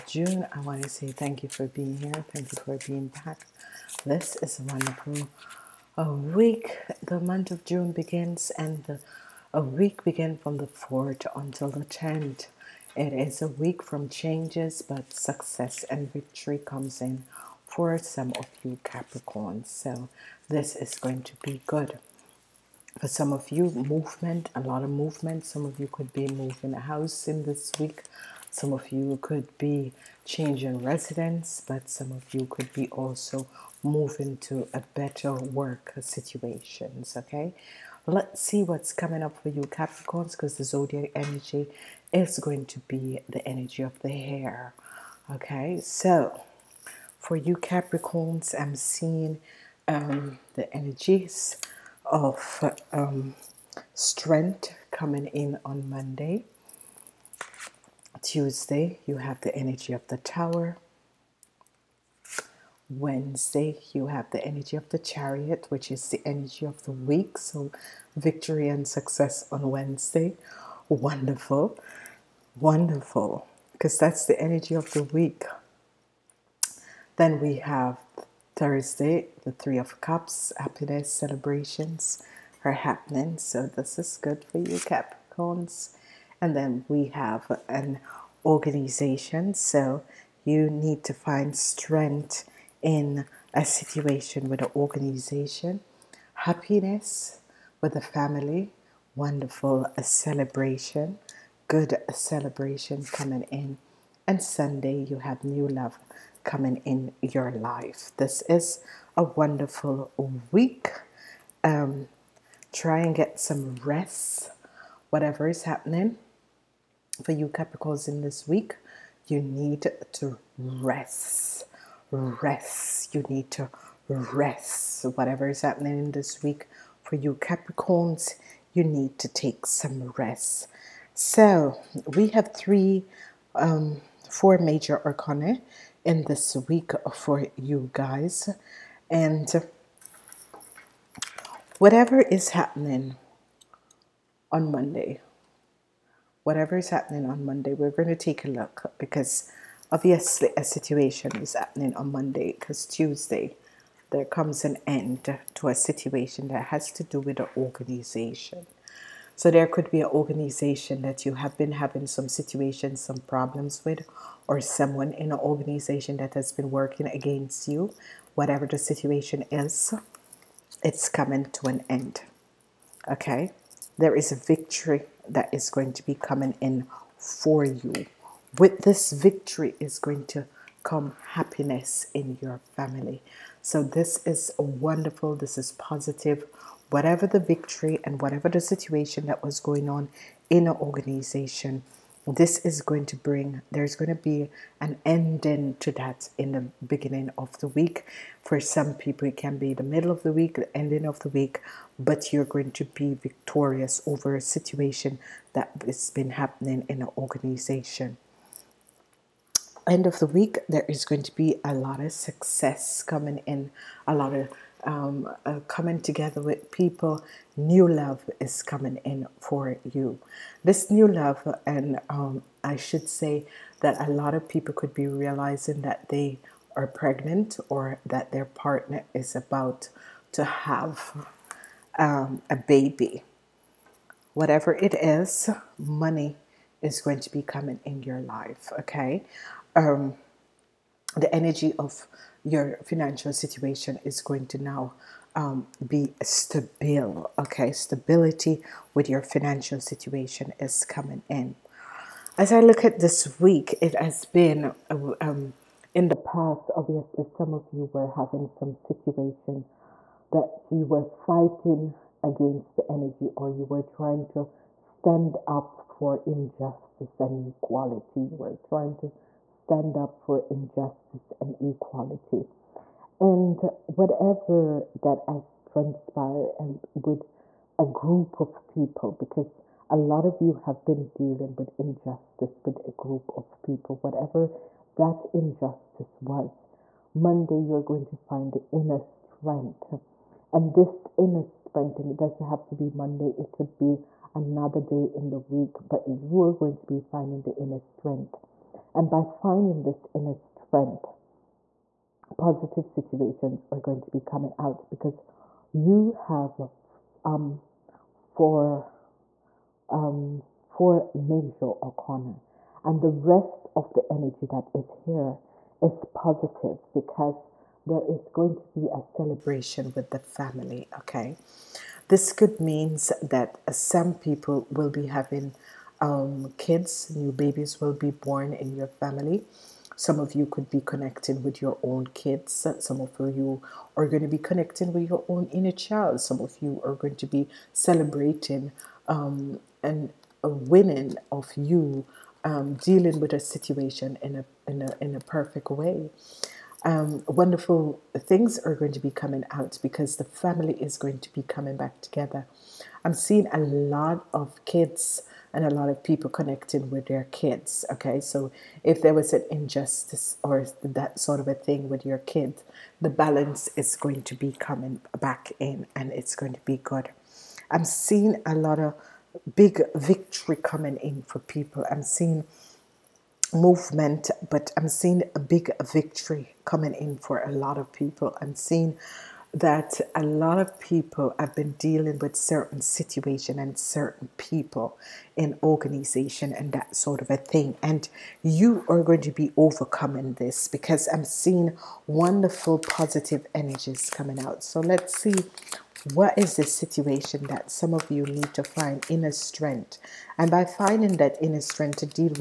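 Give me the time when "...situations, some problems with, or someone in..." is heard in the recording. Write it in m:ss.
2:42.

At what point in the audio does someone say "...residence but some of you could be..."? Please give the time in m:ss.
0:30.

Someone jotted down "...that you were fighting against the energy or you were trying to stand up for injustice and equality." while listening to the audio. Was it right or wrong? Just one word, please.
right.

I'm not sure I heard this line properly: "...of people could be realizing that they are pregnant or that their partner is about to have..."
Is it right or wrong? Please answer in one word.
right.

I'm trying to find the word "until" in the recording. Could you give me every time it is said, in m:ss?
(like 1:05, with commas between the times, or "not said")
0:11.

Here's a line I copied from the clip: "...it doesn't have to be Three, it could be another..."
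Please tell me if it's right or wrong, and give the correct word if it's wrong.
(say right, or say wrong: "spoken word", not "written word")
wrong: "Monday", not "Three".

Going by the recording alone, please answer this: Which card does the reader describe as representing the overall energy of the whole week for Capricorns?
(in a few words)
The Chariot.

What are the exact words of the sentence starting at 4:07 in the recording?
Okay, stability with your financial situation is coming in.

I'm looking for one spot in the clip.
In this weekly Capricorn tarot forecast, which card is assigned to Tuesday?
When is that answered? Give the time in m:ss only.
1:00.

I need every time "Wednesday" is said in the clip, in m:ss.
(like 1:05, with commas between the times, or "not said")
1:02, 1:09.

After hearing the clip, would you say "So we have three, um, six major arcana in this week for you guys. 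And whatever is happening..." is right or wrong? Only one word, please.
wrong.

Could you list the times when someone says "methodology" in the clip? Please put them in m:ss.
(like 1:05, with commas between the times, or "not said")
not said.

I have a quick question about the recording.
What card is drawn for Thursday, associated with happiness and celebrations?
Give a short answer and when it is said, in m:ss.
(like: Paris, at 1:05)
Three of Cups, at 1:19.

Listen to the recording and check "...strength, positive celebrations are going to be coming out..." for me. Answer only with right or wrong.
wrong.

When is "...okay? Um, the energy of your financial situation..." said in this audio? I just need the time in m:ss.
3:58.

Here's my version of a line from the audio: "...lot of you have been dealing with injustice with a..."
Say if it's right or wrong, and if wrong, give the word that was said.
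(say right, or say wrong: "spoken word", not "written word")
right.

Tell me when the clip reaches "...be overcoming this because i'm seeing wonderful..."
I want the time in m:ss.
6:29.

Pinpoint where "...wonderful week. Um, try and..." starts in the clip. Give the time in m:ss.
1:49.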